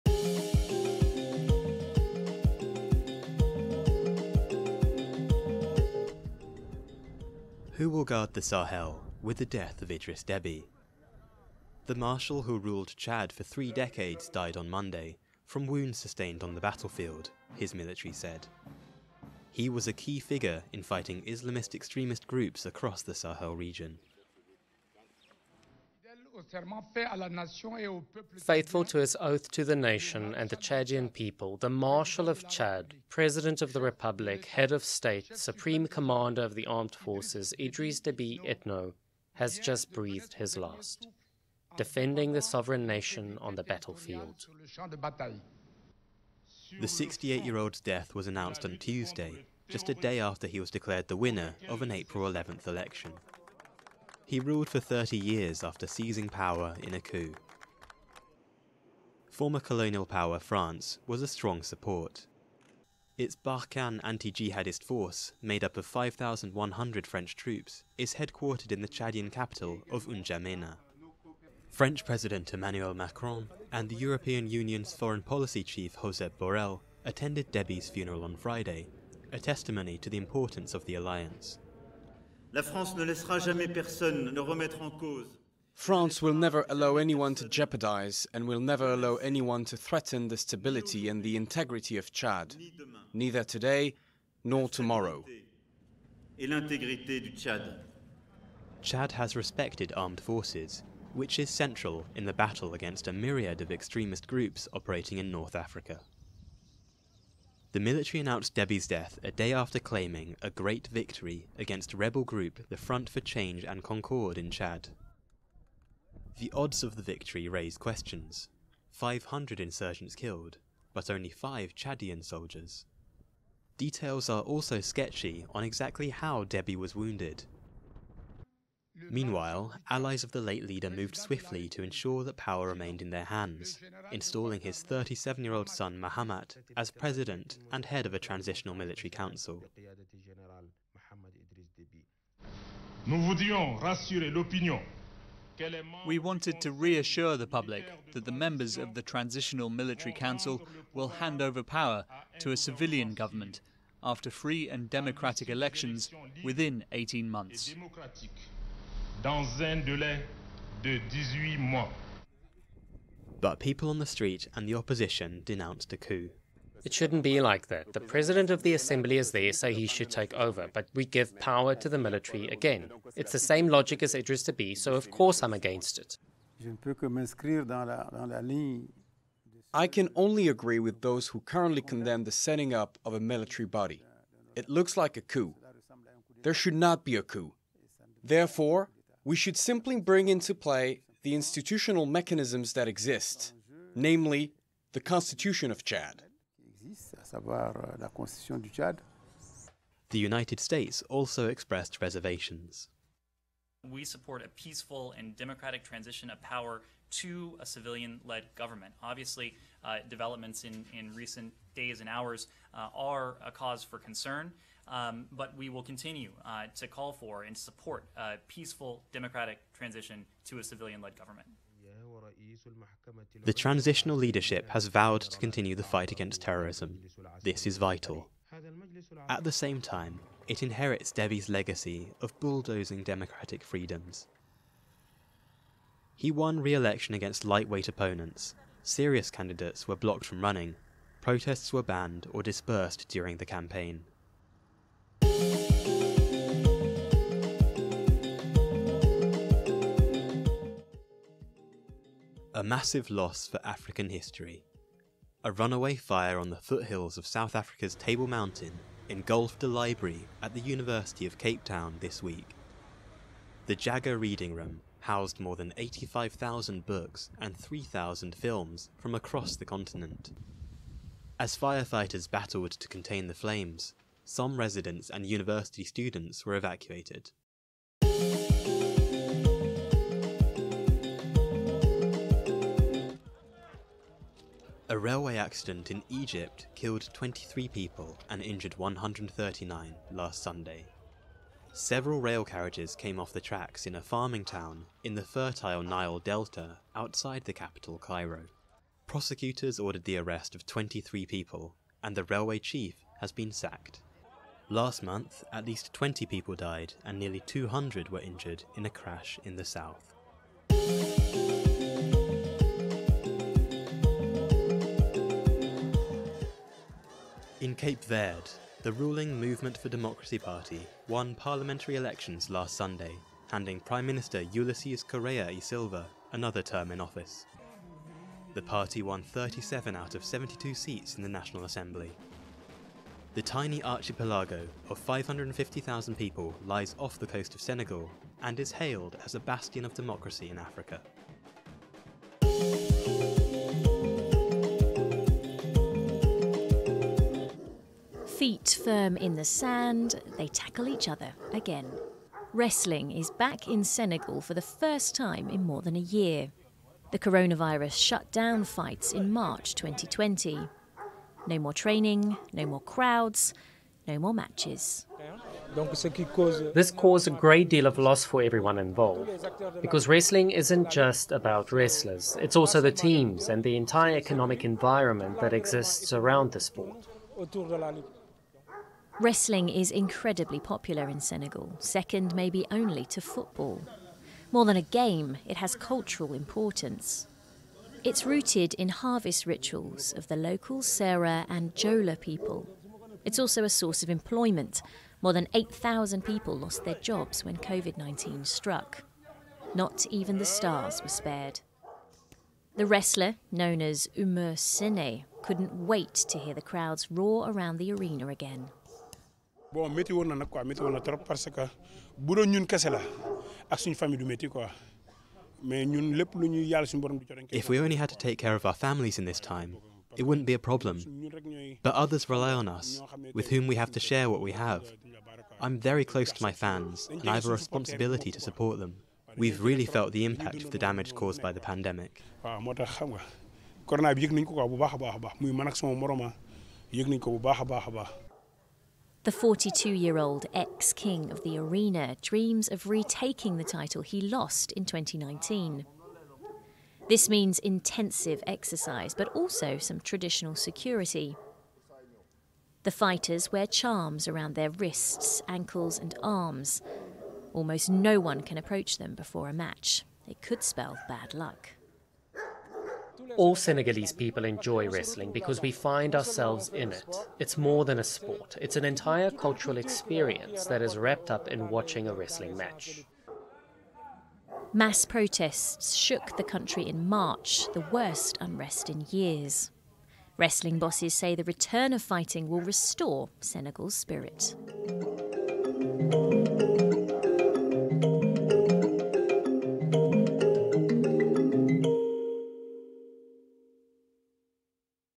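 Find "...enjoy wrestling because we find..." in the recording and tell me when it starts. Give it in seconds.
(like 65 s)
464 s.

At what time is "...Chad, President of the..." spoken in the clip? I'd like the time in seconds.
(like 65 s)
32 s.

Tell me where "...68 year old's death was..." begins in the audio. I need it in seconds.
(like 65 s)
46 s.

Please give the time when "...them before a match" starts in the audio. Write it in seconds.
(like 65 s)
458 s.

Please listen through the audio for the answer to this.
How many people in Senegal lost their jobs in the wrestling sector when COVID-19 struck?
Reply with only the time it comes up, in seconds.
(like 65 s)
395 s.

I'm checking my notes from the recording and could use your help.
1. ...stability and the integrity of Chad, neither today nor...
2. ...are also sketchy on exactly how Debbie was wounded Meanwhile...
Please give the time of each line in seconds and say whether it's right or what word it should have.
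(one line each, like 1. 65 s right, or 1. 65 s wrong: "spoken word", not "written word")
1. 90 s right
2. 124 s right.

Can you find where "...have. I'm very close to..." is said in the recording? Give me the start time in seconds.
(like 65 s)
424 s.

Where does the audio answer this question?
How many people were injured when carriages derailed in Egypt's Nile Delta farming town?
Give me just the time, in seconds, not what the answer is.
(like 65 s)
288 s.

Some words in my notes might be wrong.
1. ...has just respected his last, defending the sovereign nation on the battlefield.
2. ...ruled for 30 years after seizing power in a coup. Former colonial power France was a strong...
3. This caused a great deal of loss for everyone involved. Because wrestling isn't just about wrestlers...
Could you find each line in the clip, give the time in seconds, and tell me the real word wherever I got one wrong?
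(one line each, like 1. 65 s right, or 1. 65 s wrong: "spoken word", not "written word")
1. 39 s wrong: "breathed", not "respected"
2. 54 s right
3. 366 s right.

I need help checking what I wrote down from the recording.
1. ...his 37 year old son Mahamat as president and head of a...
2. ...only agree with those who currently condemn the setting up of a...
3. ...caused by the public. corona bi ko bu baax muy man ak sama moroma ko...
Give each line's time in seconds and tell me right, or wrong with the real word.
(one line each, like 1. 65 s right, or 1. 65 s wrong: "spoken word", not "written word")
1. 134 s right
2. 180 s right
3. 431 s wrong: "pandemic", not "public".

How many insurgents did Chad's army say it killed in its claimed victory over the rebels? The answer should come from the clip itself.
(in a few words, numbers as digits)
500.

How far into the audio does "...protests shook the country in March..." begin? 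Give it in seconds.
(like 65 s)
475 s.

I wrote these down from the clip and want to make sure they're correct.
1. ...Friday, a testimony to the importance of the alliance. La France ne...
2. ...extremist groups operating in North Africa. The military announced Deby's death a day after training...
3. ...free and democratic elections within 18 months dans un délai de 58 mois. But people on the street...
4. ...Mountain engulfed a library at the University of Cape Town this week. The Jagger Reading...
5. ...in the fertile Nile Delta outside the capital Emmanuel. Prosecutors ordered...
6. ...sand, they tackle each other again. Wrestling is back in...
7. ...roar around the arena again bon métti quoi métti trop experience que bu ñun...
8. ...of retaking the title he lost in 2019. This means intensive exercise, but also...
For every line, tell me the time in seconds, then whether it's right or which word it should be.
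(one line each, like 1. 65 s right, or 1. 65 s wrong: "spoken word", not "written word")
1. 78 s right
2. 103 s wrong: "claiming", not "training"
3. 154 s wrong: "18", not "58"
4. 258 s right
5. 295 s wrong: "Cairo", not "Emmanuel"
6. 349 s right
7. 407 s wrong: "parce", not "experience"
8. 442 s right.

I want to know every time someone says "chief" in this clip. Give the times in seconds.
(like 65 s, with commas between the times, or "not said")
75 s, 302 s.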